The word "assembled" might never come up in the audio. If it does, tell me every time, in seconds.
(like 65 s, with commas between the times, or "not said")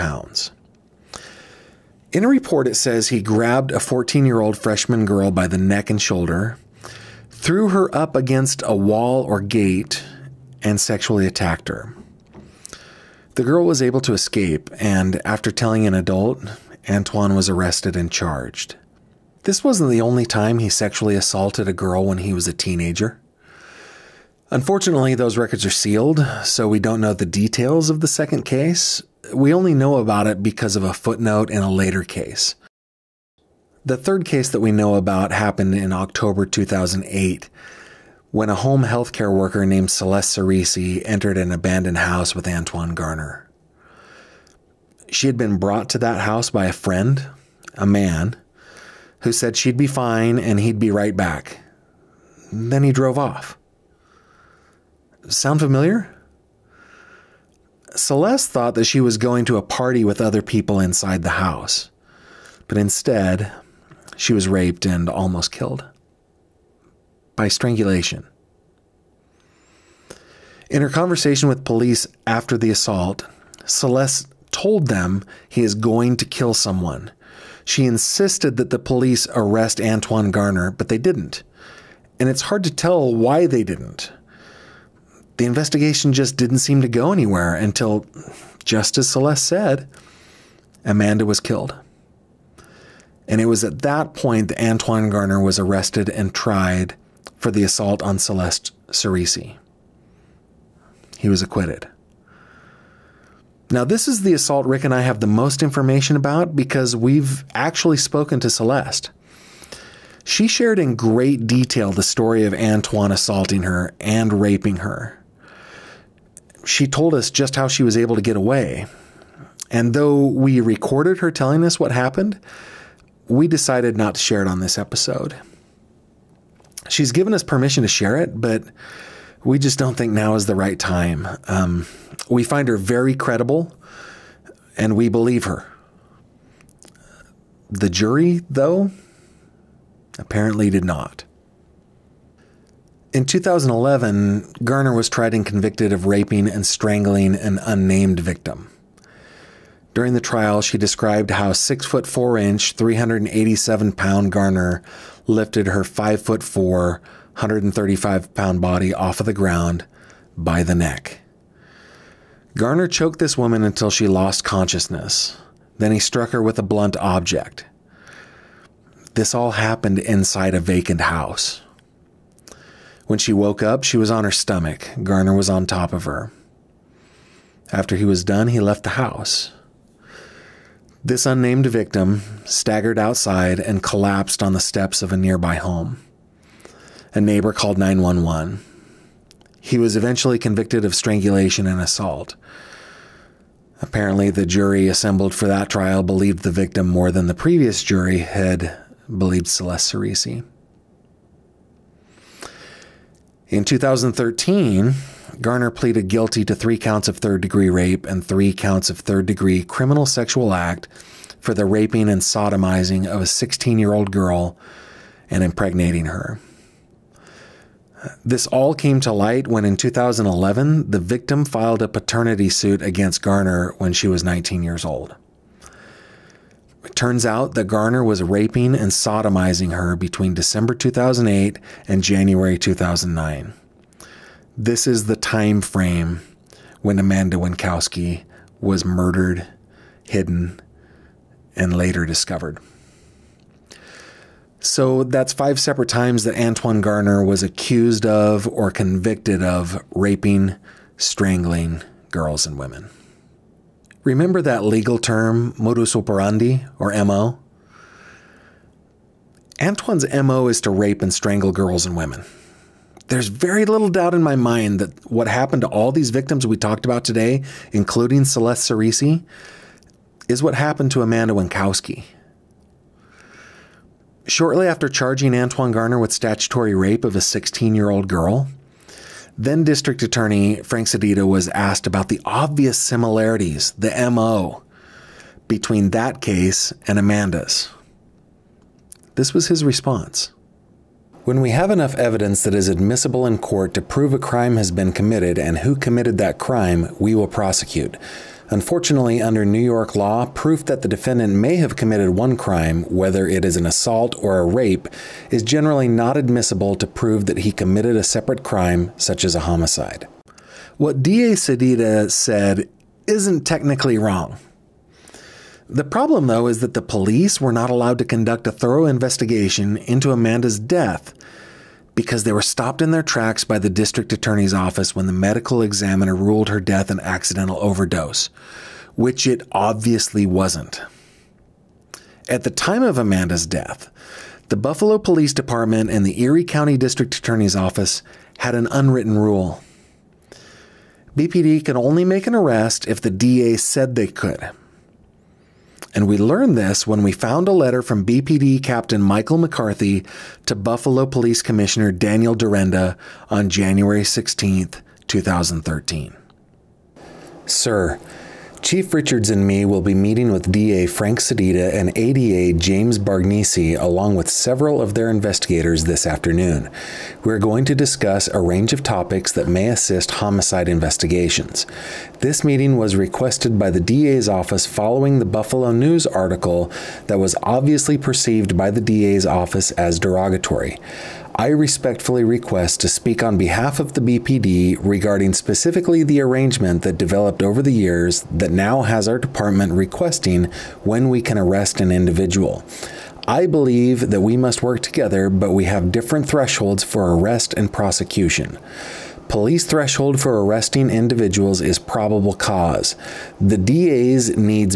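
194 s.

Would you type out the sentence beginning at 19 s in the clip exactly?
This wasn't the only time he sexually assaulted a girl when he was a teenager.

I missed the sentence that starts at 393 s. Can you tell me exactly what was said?
I believe that we must work together, but we have different thresholds for arrest and prosecution.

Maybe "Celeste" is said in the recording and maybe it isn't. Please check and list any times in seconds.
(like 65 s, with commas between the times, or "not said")
39 s, 57 s, 73 s, 89 s, 98 s, 108 s, 199 s, 268 s.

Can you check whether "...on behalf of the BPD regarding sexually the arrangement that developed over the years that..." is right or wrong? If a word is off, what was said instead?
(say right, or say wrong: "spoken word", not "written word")
wrong: "specifically", not "sexually".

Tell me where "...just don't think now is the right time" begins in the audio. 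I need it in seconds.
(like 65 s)
129 s.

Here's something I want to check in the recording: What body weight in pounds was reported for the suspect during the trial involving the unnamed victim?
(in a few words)
387.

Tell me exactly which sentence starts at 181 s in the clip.
This unnamed victim staggered outside and collapsed on the steps of a nearby home.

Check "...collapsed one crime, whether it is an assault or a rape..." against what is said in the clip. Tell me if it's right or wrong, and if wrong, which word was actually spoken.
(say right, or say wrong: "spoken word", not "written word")
wrong: "committed", not "collapsed".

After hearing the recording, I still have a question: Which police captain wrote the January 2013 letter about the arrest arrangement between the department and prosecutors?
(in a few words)
Michael McCarthy.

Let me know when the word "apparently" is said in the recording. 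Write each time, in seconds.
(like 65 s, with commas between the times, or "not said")
140 s, 193 s.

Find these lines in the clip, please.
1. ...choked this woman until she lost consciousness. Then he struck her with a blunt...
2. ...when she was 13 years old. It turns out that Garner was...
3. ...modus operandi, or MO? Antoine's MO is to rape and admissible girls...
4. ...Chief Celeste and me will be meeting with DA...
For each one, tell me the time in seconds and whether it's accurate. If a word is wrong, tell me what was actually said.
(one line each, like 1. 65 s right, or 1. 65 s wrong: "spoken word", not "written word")
1. 162 s right
2. 223 s wrong: "19", not "13"
3. 255 s wrong: "strangle", not "admissible"
4. 358 s wrong: "Richards", not "Celeste".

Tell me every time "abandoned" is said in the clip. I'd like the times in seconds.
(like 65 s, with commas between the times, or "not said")
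41 s.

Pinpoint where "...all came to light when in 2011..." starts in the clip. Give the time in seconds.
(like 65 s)
218 s.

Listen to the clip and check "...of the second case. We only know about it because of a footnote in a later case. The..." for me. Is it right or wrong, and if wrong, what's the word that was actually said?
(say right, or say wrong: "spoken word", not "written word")
right.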